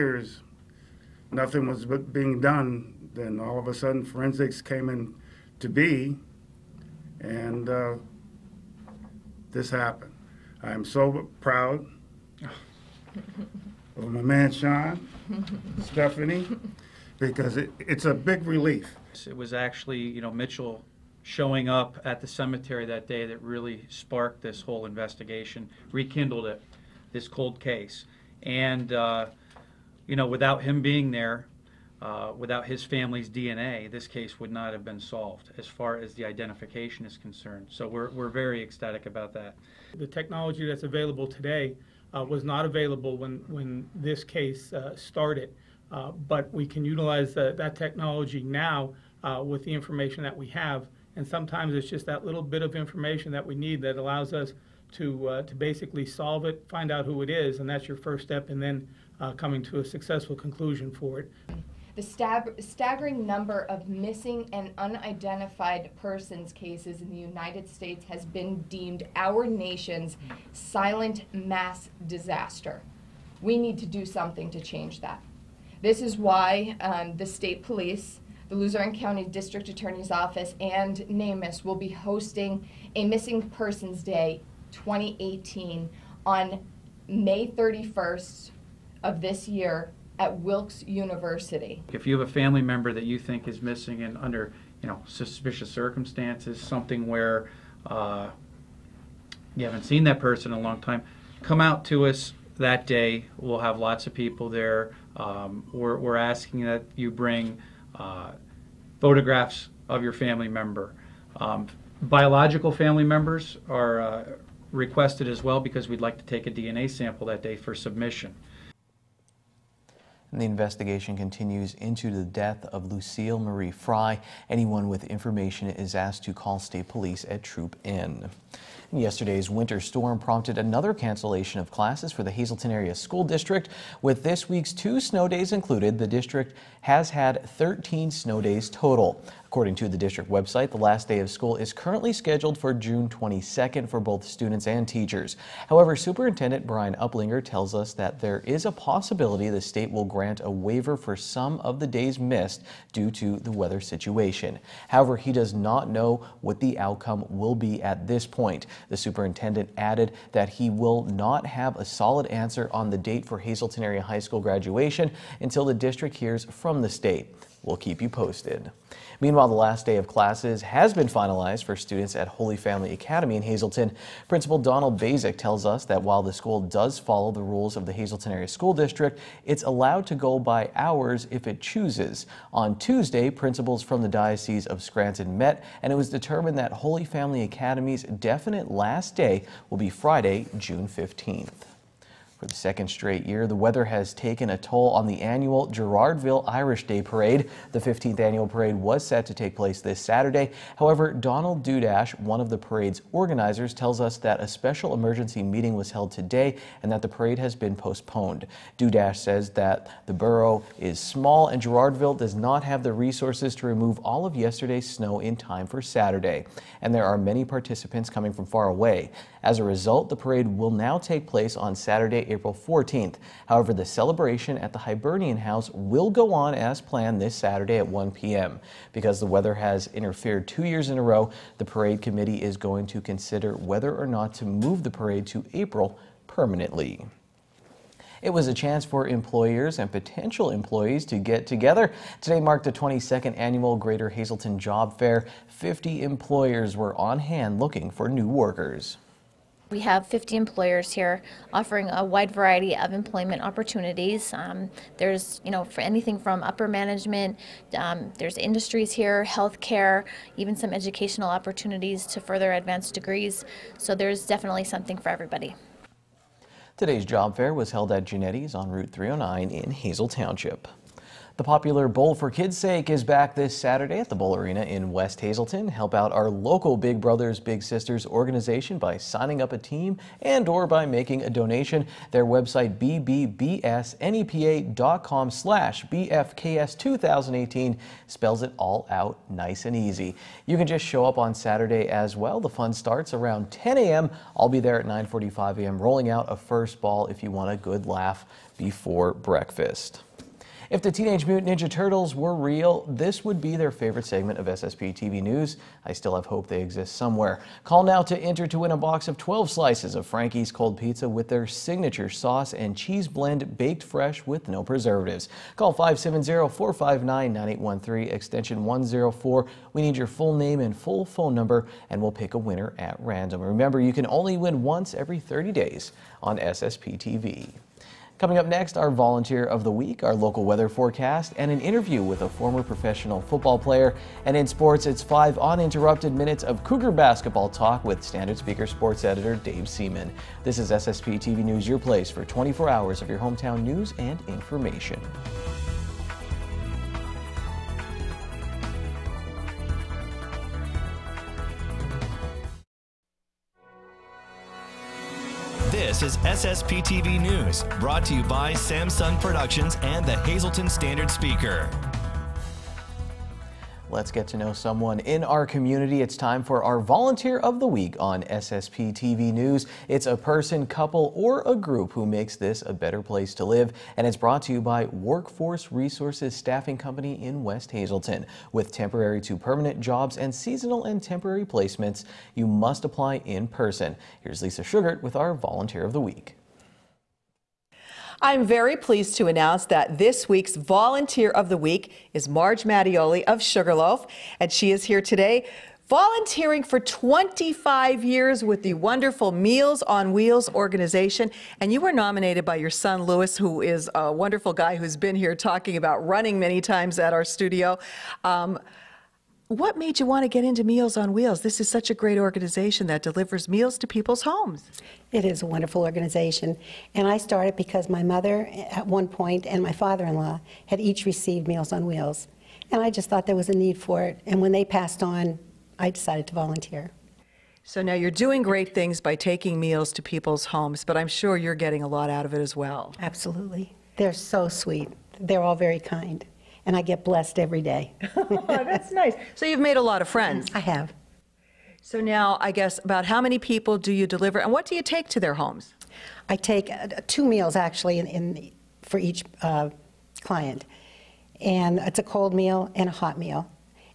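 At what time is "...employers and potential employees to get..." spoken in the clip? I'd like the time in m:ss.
3:59.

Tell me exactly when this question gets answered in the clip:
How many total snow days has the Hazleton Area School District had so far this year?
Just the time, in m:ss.
2:17.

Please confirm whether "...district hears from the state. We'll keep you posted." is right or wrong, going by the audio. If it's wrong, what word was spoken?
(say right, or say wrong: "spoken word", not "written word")
right.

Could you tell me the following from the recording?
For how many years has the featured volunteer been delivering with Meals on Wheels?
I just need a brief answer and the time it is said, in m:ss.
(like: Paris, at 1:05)
25 years, at 6:36.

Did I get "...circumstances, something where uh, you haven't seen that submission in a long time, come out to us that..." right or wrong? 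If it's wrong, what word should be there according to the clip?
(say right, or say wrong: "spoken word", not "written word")
wrong: "person", not "submission".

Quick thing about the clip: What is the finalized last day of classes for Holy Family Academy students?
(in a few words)
Friday, June 15th.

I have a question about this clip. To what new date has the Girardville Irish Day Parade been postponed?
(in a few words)
Saturday, April 14th.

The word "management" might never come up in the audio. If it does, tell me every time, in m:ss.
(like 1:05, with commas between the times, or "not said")
4:16.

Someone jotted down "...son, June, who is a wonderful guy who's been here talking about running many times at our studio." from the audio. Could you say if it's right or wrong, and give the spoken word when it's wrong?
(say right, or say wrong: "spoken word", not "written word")
wrong: "Lewis", not "June".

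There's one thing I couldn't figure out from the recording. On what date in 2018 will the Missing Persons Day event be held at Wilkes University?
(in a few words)
May 31st.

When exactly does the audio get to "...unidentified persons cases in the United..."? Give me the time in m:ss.
1:04.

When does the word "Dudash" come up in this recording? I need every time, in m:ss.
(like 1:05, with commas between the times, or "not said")
3:21, 3:28.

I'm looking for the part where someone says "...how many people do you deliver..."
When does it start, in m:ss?
7:23.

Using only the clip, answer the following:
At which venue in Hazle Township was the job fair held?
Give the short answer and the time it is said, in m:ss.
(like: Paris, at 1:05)
Genetti's, at 4:28.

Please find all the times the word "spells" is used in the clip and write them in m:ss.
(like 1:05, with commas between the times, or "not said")
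4:48.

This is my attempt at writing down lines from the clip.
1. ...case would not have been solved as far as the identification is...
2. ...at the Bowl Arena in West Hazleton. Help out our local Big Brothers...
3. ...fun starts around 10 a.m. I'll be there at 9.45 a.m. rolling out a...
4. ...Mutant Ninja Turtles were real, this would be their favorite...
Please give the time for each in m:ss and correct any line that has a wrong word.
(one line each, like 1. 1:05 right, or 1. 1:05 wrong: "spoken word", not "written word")
1. 0:34 right
2. 4:33 right
3. 4:52 right
4. 5:01 right.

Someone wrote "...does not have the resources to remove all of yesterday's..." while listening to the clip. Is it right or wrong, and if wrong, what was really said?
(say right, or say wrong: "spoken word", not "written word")
right.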